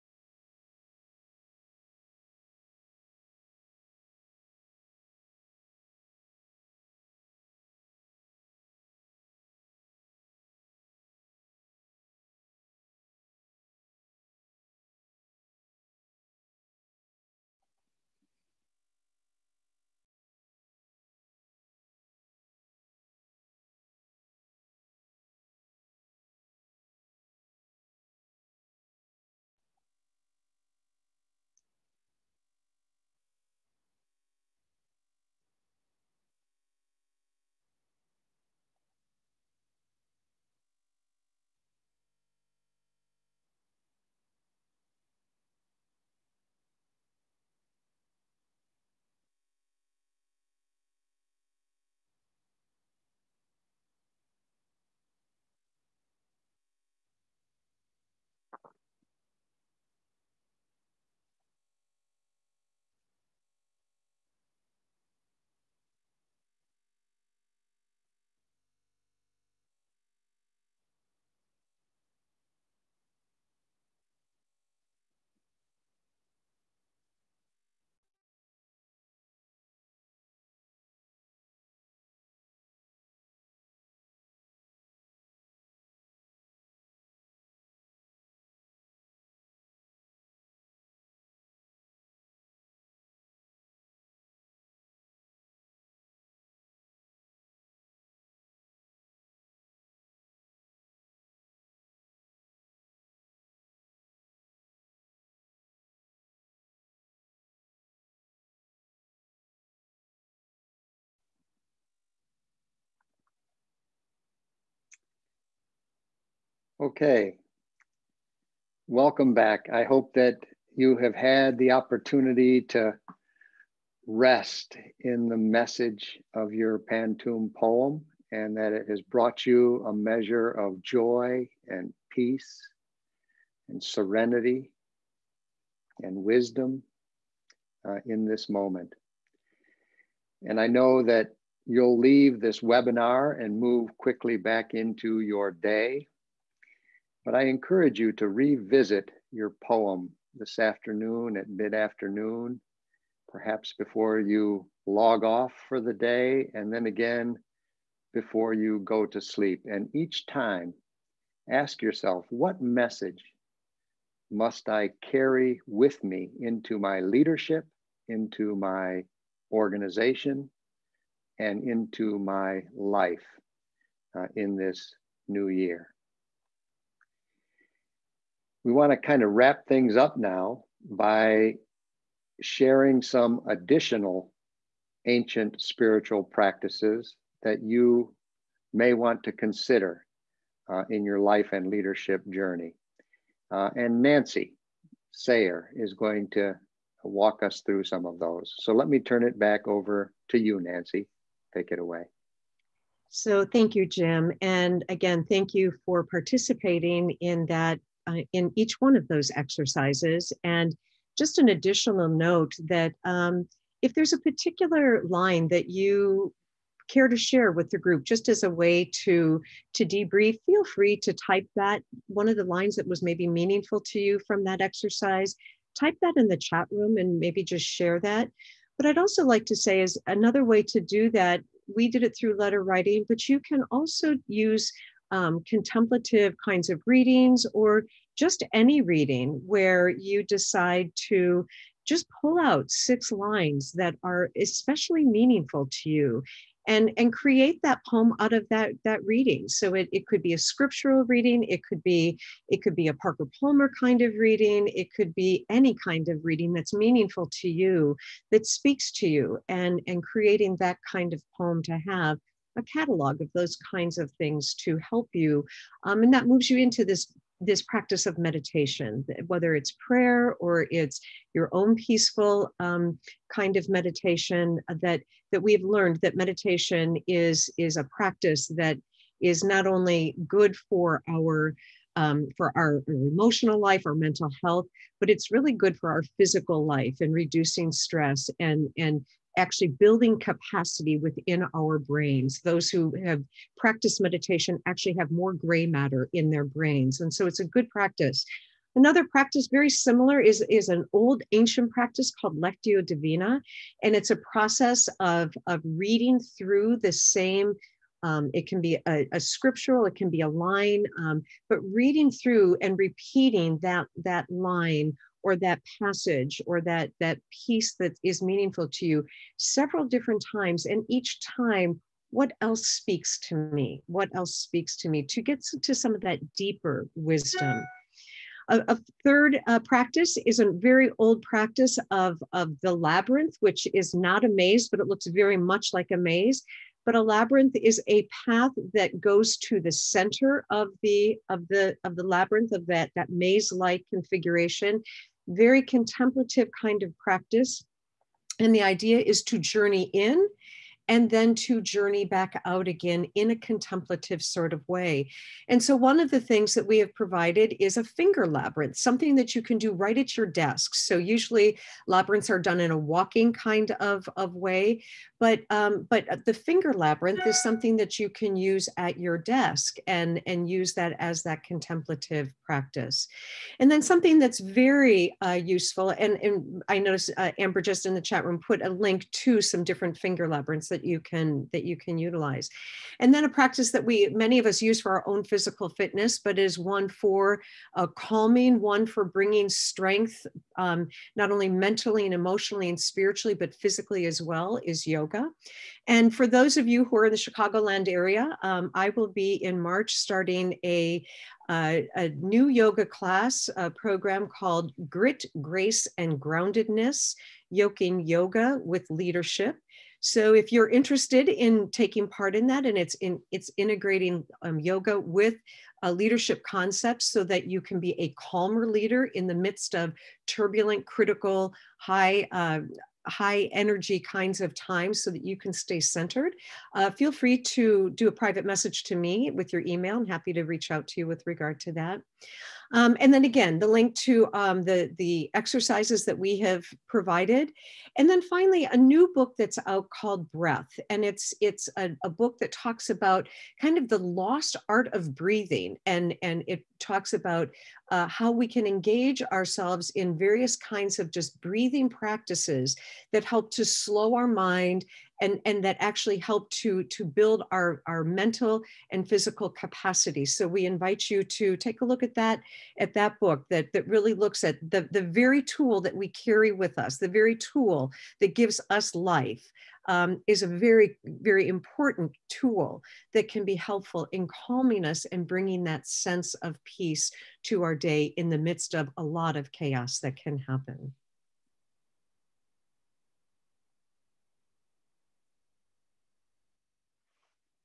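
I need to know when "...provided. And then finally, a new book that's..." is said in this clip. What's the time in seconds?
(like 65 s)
436 s.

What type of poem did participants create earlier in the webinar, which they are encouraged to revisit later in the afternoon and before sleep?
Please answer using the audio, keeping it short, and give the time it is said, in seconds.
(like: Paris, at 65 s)
Pantoum, at 126 s.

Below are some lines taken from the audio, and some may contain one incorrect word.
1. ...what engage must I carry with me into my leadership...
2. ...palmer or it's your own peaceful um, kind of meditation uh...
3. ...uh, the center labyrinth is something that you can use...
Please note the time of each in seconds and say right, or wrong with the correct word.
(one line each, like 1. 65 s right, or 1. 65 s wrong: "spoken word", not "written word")
1. 162 s wrong: "message", not "engage"
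2. 269 s wrong: "prayer", not "palmer"
3. 366 s wrong: "finger", not "center".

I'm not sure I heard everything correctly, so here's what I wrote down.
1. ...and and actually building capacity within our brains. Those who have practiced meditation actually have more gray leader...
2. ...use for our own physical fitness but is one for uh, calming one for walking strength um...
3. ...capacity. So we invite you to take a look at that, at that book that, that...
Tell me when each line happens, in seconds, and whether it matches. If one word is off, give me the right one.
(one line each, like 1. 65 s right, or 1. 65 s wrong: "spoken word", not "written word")
1. 288 s wrong: "matter", not "leader"
2. 384 s wrong: "bringing", not "walking"
3. 459 s right.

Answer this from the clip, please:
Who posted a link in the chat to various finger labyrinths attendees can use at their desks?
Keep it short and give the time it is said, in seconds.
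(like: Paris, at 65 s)
Amber, at 377 s.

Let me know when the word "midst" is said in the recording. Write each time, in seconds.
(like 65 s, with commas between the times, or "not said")
419 s, 478 s.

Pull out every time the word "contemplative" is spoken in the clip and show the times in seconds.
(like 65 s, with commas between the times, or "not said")
235 s, 345 s, 353 s, 371 s.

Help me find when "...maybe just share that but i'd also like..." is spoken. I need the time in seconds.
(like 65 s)
227 s.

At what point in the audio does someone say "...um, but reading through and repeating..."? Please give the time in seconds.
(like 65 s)
310 s.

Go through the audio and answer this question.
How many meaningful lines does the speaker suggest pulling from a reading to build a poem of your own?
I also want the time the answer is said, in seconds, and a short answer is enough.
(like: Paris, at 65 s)
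6, at 242 s.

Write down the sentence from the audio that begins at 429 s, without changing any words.
I'm happy to reach out to you with regard to that.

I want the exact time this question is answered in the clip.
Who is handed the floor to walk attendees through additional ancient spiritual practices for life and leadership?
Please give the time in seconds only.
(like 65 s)
194 s.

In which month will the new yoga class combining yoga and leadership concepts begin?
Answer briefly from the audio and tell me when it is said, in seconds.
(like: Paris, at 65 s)
March, at 399 s.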